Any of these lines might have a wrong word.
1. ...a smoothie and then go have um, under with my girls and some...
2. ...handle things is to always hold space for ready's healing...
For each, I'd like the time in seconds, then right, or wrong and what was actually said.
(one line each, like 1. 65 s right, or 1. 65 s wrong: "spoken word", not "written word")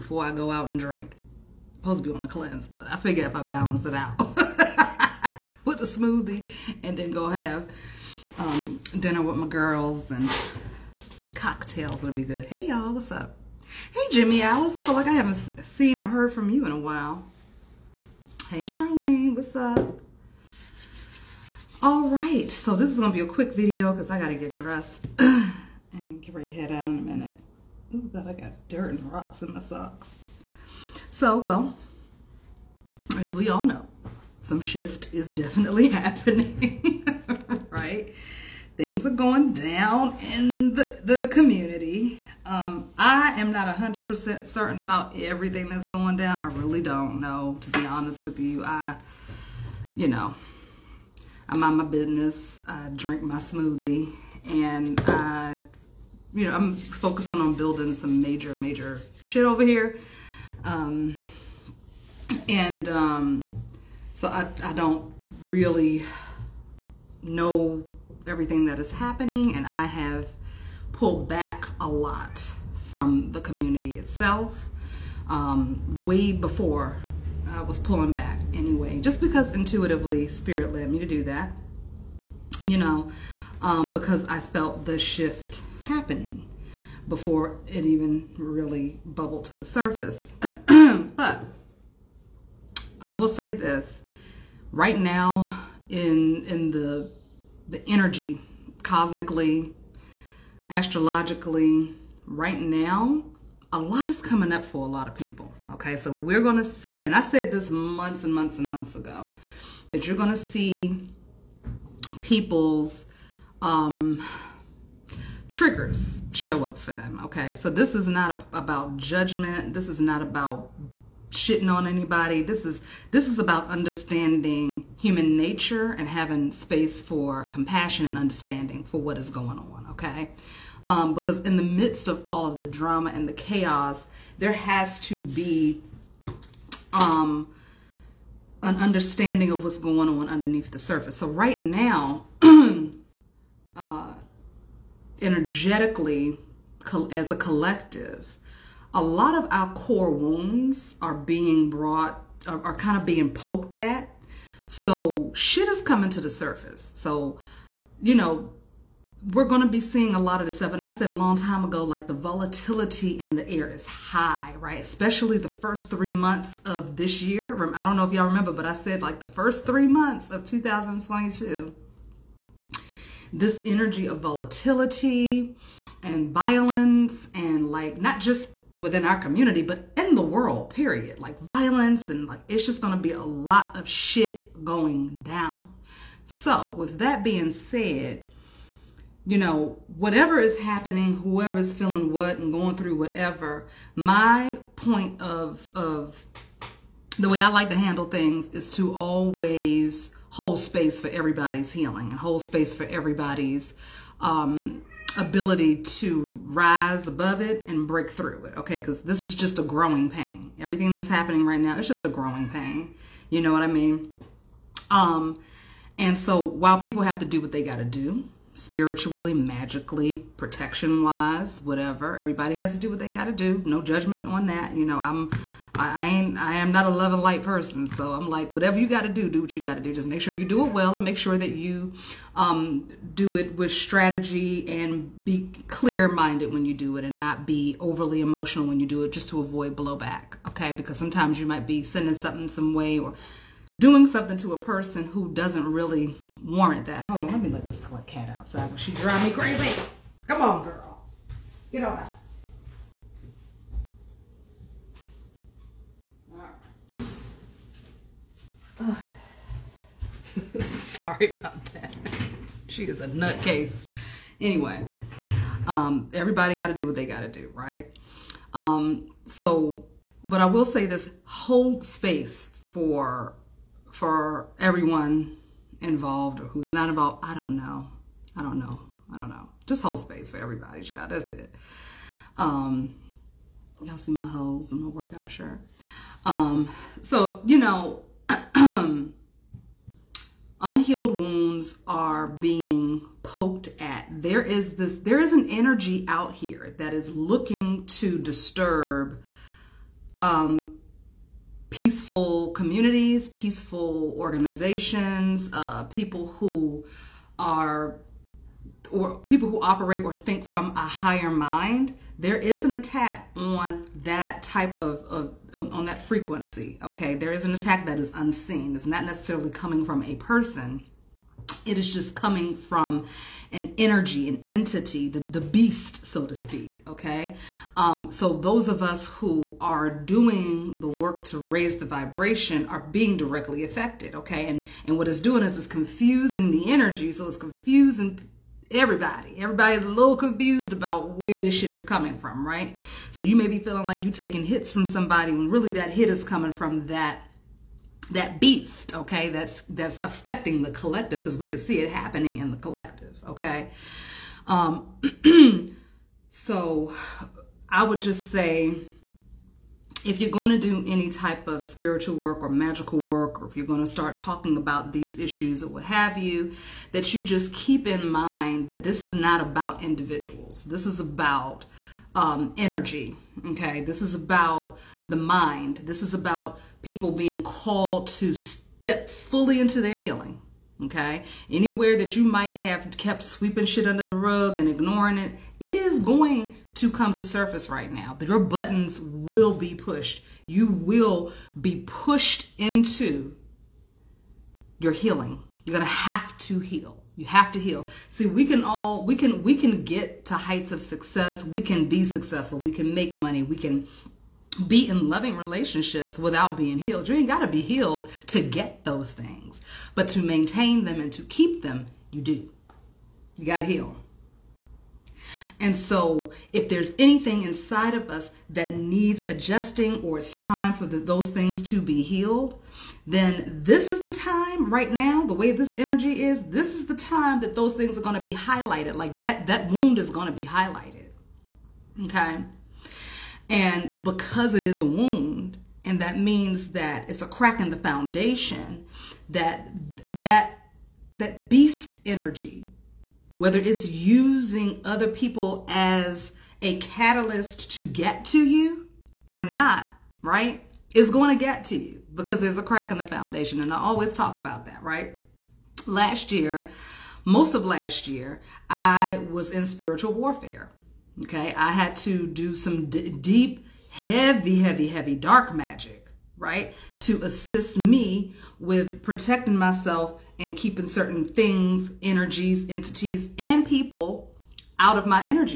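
1. 5 s wrong: "dinner", not "under"
2. 197 s wrong: "everybody", not "ready".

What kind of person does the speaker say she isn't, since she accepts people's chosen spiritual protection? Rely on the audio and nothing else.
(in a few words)
love and light.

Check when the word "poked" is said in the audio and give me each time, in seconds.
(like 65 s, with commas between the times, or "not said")
153 s, 293 s.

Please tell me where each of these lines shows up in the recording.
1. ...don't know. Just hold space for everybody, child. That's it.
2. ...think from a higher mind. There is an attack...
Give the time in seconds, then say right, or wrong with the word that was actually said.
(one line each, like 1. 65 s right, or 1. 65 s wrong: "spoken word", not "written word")
1. 279 s right
2. 310 s right.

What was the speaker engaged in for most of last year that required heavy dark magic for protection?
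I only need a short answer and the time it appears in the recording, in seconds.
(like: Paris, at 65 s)
spiritual warfare, at 459 s.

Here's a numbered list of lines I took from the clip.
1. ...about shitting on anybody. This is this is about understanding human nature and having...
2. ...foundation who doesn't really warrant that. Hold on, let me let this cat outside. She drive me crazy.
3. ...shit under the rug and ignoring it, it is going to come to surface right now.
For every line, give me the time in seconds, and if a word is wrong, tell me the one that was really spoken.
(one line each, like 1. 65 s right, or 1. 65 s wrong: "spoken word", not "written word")
1. 120 s right
2. 244 s wrong: "person", not "foundation"
3. 383 s right.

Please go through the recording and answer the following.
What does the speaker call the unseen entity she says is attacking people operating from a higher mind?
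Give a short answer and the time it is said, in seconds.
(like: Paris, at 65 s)
the beast, at 325 s.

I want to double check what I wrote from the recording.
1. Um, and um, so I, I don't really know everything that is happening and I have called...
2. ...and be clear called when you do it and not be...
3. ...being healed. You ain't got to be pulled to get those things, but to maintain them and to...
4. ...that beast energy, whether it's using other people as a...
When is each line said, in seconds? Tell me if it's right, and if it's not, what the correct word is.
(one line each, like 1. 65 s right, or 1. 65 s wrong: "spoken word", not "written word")
1. 60 s wrong: "pulled", not "called"
2. 234 s wrong: "minded", not "called"
3. 406 s wrong: "healed", not "pulled"
4. 441 s right.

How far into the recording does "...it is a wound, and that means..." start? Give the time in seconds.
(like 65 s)
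434 s.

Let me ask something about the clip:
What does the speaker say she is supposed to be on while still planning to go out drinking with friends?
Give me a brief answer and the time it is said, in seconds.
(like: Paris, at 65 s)
a cleanse, at 2 s.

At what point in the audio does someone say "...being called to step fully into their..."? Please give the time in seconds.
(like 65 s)
377 s.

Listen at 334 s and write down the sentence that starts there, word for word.
And, and what it's doing is it's confusing the energy, so it's confusing everybody.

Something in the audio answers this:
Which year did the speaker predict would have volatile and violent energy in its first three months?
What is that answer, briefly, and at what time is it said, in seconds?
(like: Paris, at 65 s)
2022, at 170 s.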